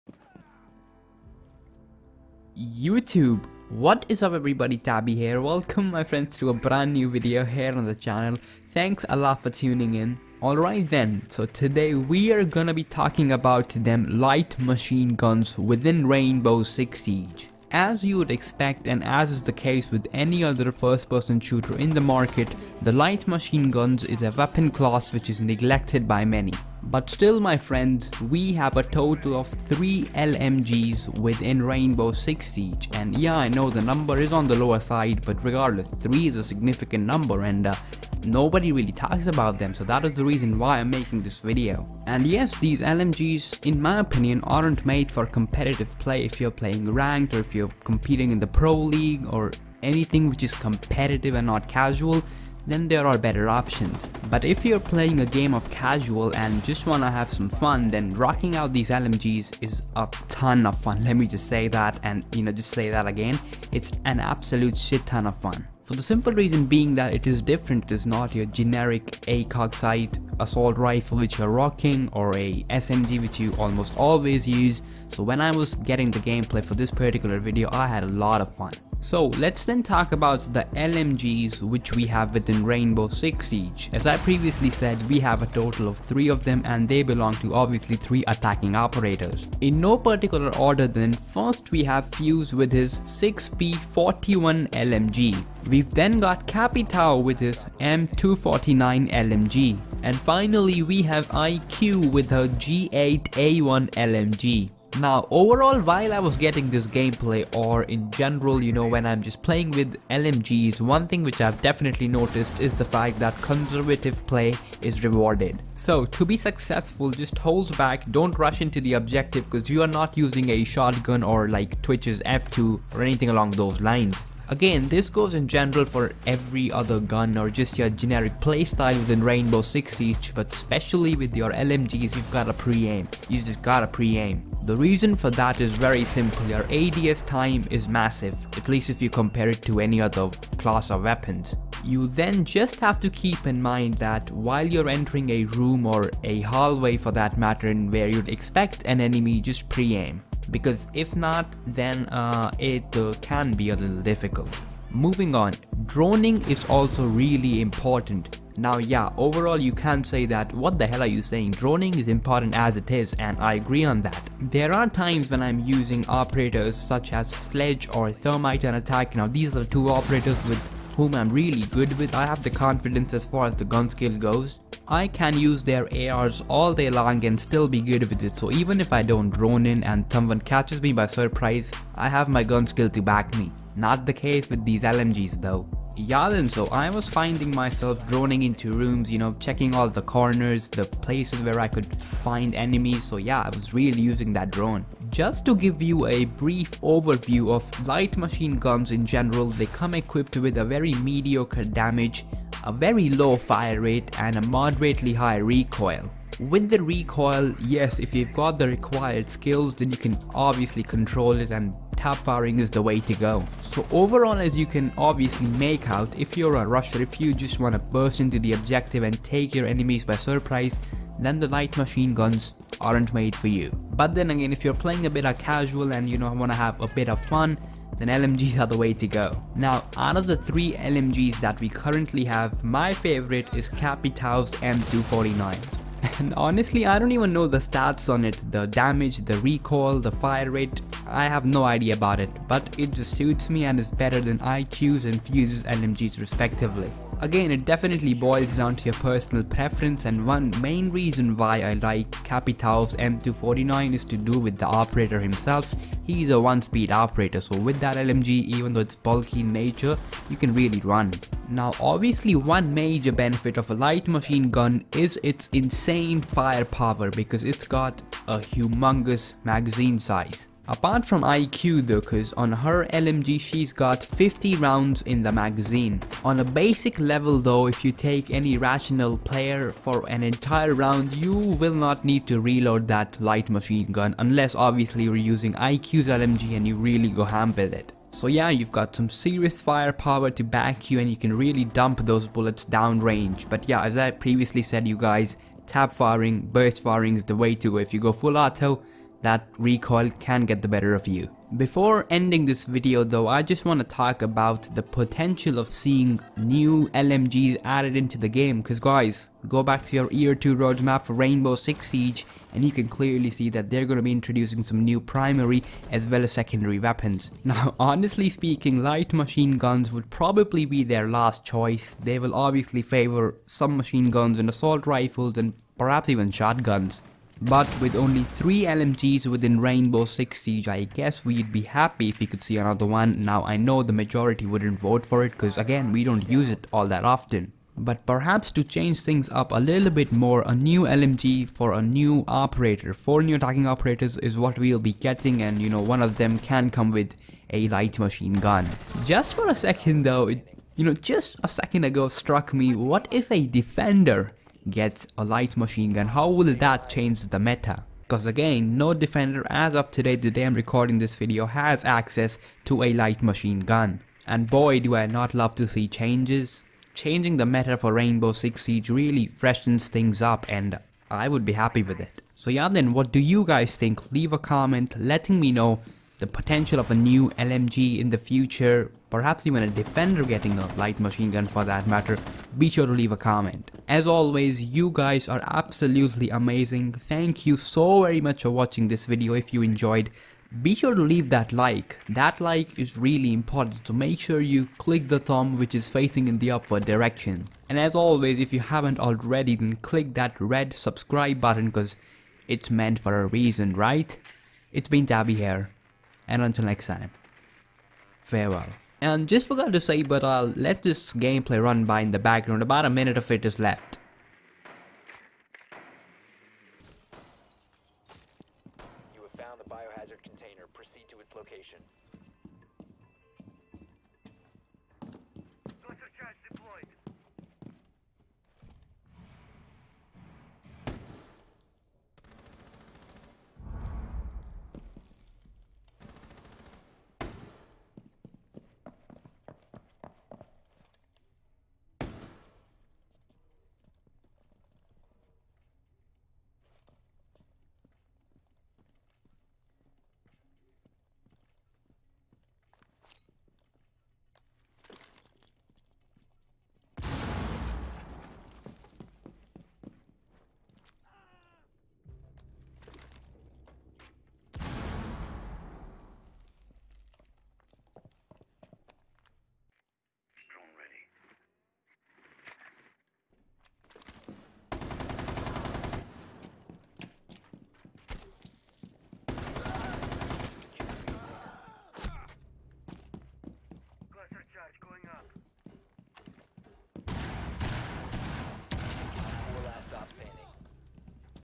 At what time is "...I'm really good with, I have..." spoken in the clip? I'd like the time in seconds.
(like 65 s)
171 s.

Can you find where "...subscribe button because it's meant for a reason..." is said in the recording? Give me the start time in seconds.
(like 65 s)
400 s.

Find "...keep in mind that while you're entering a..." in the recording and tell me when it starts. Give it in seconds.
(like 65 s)
143 s.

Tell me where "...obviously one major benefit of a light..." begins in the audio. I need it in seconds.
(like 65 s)
261 s.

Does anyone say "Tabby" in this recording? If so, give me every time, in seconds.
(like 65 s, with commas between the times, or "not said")
4 s, 405 s.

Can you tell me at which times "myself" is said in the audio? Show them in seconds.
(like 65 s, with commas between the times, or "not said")
187 s.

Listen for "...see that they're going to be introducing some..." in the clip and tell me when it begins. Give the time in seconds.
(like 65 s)
313 s.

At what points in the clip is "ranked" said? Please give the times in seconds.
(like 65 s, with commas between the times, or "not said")
46 s.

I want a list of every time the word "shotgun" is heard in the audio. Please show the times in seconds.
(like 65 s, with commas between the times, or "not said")
120 s, 326 s.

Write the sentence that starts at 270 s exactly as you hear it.
Apart from IQ though cause on her LMG she's got 50 rounds in the magazine.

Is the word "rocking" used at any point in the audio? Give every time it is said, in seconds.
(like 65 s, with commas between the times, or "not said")
58 s, 71 s.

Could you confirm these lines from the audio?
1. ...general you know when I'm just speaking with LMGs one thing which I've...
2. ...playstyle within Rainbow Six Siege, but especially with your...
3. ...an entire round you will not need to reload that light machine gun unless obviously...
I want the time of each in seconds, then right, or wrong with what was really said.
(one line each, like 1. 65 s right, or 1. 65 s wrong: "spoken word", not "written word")
1. 108 s wrong: "playing", not "speaking"
2. 128 s right
3. 280 s right.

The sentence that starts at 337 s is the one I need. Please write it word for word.
But perhaps to change things up a little bit more, a new LMG for a new operator.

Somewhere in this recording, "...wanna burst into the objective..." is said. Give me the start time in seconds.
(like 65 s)
217 s.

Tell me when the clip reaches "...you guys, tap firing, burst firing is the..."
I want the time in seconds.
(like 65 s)
294 s.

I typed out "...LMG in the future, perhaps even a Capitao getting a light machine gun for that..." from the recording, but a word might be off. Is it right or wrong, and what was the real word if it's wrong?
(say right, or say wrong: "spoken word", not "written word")
wrong: "Defender", not "Capitao".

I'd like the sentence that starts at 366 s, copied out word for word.
Changing the meta for Rainbow Six Siege really freshens things up and I would be happy with it.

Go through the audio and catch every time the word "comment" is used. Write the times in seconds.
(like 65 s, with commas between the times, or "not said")
374 s, 383 s.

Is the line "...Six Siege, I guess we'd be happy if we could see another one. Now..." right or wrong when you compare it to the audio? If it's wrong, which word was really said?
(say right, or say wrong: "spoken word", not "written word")
right.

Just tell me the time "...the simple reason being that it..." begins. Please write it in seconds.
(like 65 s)
65 s.